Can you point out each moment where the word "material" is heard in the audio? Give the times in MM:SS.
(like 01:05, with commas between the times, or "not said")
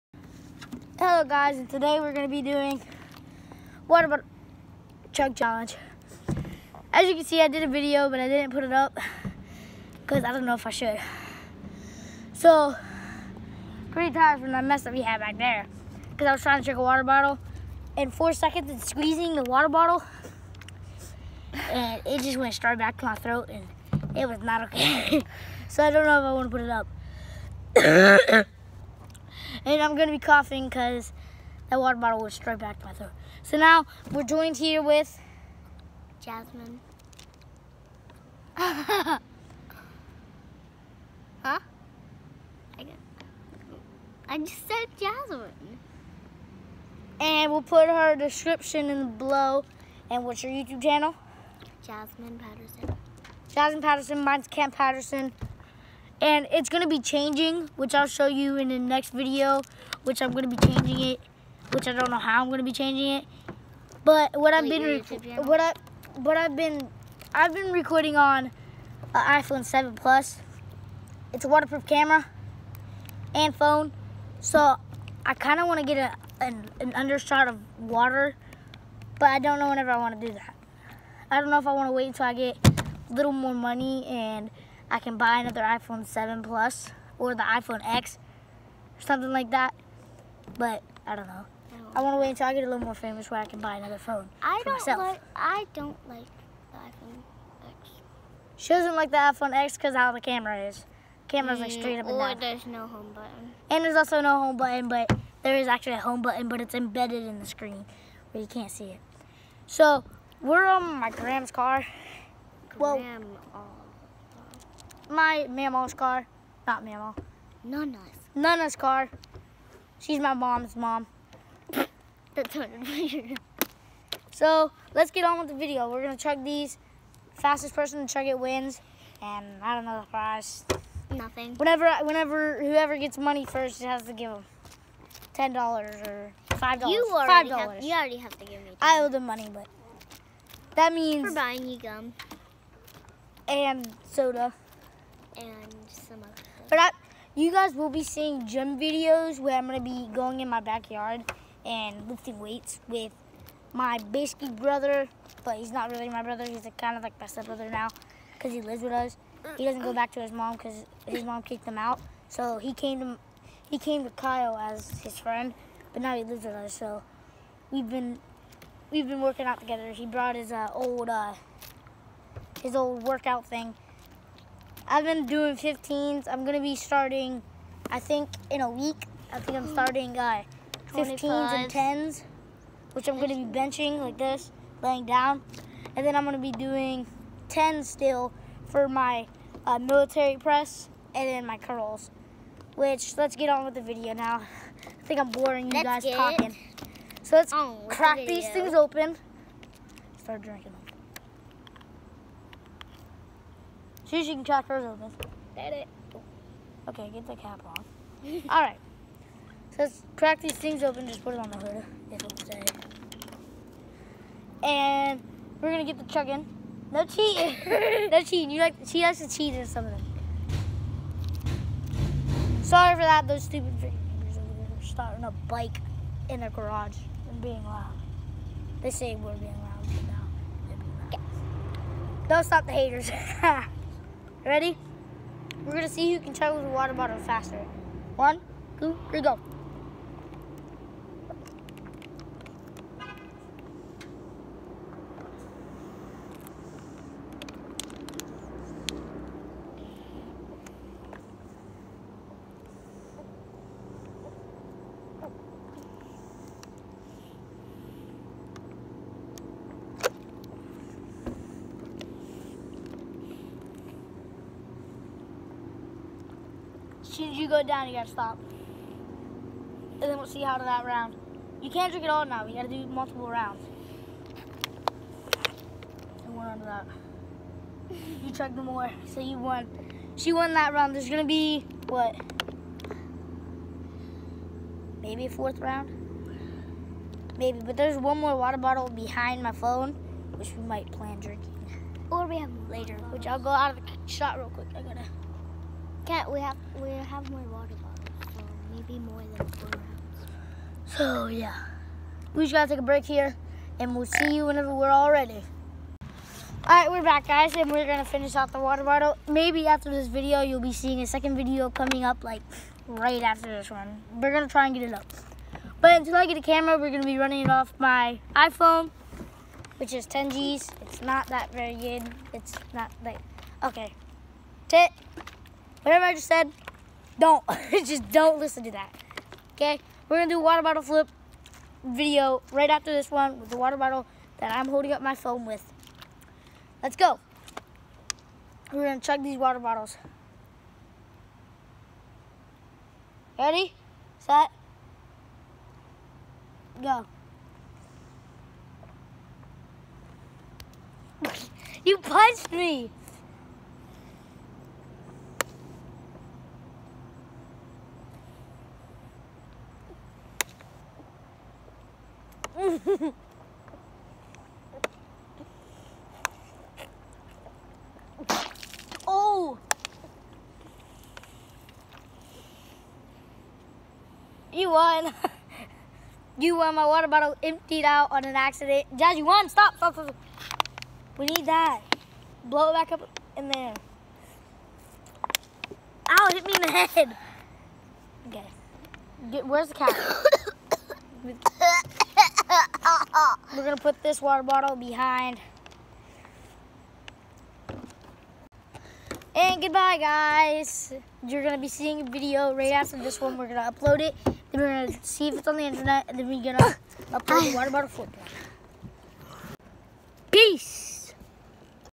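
not said.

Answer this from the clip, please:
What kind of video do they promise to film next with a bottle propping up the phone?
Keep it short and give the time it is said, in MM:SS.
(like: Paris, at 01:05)
water bottle flip, at 05:30.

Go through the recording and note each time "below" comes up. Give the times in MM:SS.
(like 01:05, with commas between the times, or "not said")
00:49.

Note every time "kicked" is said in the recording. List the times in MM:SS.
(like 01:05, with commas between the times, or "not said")
02:41.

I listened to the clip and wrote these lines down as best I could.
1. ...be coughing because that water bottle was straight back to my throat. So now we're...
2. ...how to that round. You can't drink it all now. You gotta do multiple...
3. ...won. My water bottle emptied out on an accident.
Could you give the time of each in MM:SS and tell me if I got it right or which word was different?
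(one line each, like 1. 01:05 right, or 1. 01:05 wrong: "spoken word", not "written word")
1. 00:30 right
2. 04:30 right
3. 06:16 right.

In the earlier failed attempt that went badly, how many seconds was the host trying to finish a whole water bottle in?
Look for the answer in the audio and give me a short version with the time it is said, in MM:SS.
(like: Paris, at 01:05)
4 seconds, at 00:18.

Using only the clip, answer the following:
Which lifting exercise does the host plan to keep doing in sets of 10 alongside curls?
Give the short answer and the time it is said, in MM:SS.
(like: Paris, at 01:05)
military press, at 03:09.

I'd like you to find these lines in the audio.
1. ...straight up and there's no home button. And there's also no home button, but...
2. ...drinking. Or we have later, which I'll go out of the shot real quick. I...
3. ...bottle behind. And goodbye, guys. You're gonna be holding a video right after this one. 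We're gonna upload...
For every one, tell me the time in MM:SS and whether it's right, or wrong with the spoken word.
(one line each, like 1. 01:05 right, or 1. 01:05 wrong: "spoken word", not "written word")
1. 01:41 right
2. 04:51 right
3. 06:34 wrong: "seeing", not "holding".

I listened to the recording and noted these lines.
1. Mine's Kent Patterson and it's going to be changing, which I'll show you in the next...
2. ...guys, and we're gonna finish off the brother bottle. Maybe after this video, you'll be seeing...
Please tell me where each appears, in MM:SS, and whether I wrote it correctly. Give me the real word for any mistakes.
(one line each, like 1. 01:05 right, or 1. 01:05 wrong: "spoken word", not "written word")
1. 00:54 right
2. 05:07 wrong: "water", not "brother".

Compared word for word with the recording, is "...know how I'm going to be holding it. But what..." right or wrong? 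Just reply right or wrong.
wrong.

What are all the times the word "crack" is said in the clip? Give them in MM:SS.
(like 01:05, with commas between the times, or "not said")
03:17, 03:24, 03:30.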